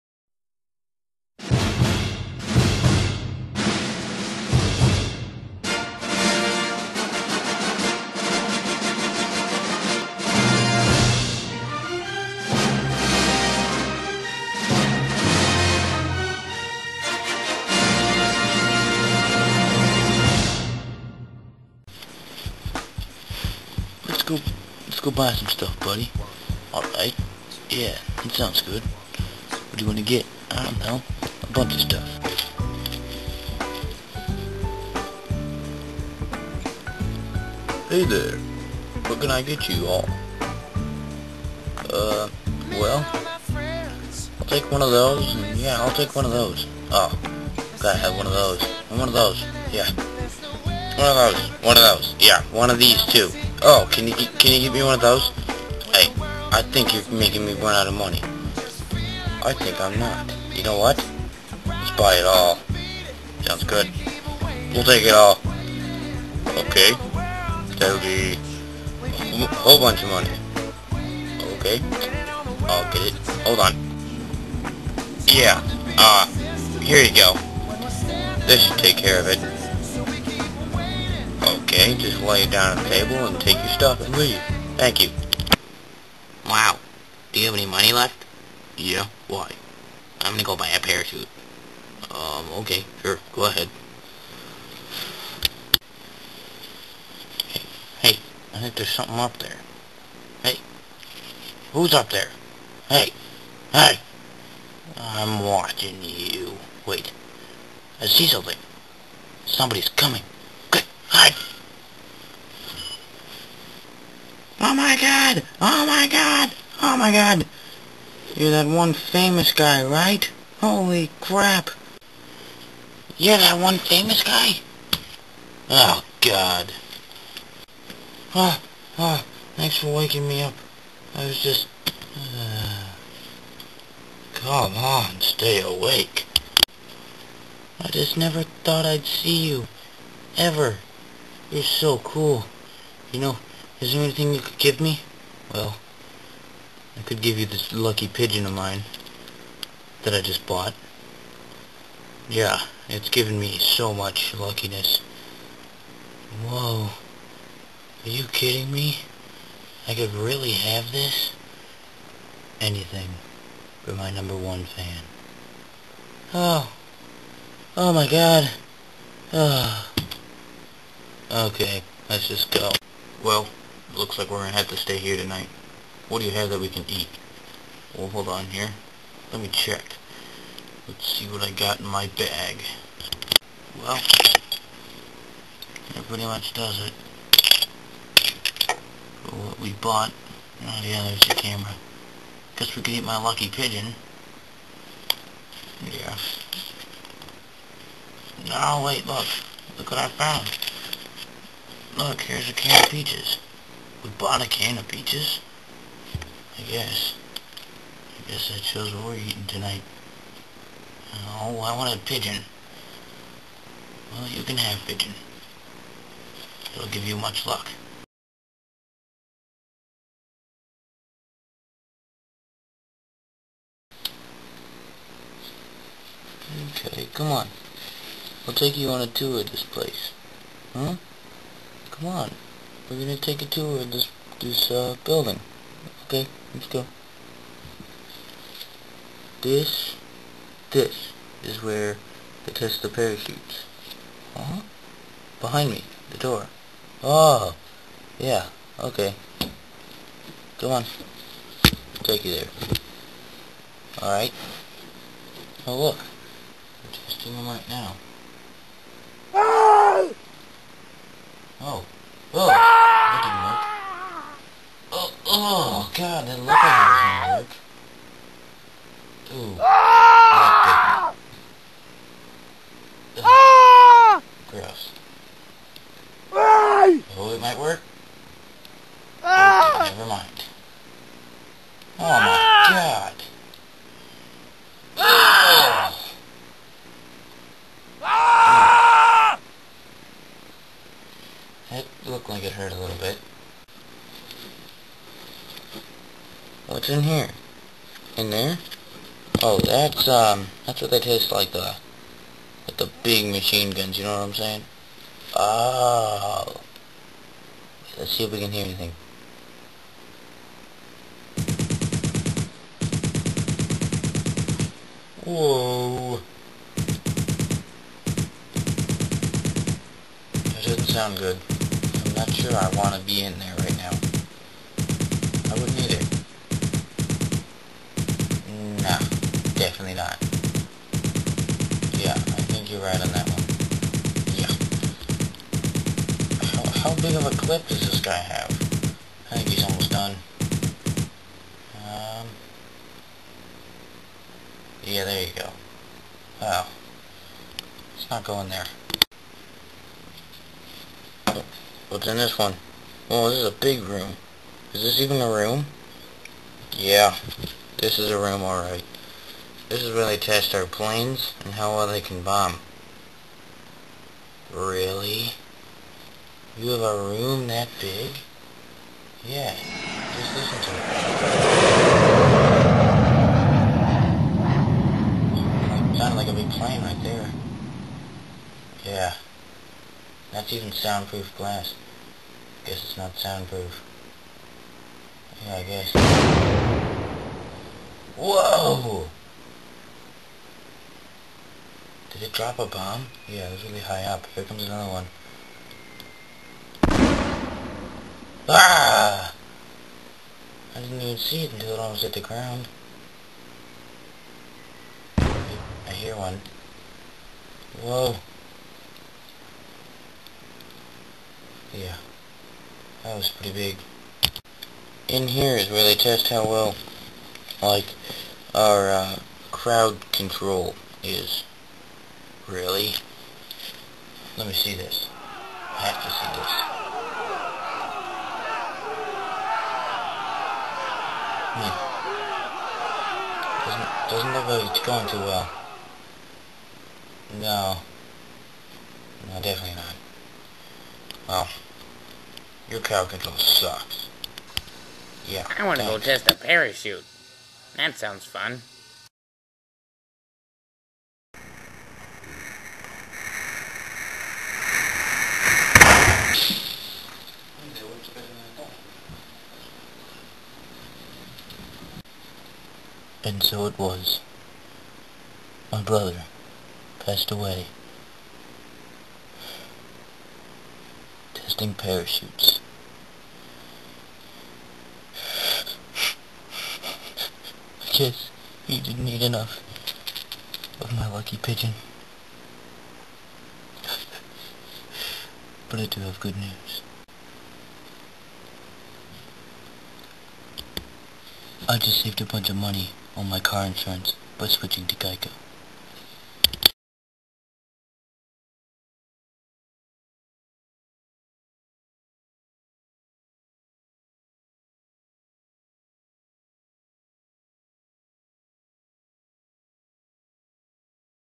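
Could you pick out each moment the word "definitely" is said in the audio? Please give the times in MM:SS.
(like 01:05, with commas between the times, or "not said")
05:29, 07:19.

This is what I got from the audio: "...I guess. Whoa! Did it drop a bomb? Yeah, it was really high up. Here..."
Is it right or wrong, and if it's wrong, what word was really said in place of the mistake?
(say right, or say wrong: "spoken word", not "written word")
right.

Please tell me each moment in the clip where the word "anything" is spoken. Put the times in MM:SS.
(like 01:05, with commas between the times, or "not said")
02:24, 02:42, 05:08.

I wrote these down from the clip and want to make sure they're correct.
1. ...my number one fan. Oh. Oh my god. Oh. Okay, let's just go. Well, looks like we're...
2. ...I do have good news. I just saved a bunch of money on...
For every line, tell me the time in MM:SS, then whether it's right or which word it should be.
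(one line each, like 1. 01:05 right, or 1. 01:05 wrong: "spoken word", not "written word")
1. 02:43 right
2. 08:05 right.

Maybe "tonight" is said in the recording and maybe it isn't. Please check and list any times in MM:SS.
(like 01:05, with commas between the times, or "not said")
02:55, 03:29.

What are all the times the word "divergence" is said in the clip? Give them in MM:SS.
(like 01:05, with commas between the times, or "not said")
not said.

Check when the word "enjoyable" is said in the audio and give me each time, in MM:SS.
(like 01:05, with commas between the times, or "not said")
not said.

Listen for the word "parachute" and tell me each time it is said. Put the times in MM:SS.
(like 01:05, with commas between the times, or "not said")
01:30, 04:02, 07:26, 07:51.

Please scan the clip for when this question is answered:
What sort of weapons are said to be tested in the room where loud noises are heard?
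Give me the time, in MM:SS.
05:03.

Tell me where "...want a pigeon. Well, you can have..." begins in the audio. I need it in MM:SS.
03:31.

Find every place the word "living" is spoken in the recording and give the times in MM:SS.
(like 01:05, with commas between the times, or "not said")
not said.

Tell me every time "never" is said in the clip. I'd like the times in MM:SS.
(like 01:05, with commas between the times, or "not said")
02:18, 04:39.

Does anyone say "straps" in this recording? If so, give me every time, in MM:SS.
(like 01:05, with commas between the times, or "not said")
not said.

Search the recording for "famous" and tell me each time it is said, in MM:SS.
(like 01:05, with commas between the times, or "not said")
01:58, 02:03.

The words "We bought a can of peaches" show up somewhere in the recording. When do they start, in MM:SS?
03:24.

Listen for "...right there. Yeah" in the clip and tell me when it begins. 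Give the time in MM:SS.
06:16.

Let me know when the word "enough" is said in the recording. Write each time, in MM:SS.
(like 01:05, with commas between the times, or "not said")
07:59.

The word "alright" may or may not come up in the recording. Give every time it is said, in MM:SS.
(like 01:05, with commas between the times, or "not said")
00:26, 05:58.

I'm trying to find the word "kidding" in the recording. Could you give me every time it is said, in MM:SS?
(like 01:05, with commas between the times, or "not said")
02:38.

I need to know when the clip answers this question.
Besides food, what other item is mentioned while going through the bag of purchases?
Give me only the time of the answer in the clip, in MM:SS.
03:11.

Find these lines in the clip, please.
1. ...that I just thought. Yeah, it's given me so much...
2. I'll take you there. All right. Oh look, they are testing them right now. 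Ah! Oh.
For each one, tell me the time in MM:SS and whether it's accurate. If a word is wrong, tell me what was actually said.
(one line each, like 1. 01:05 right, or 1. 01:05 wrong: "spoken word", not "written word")
1. 02:30 wrong: "bought", not "thought"
2. 04:11 right.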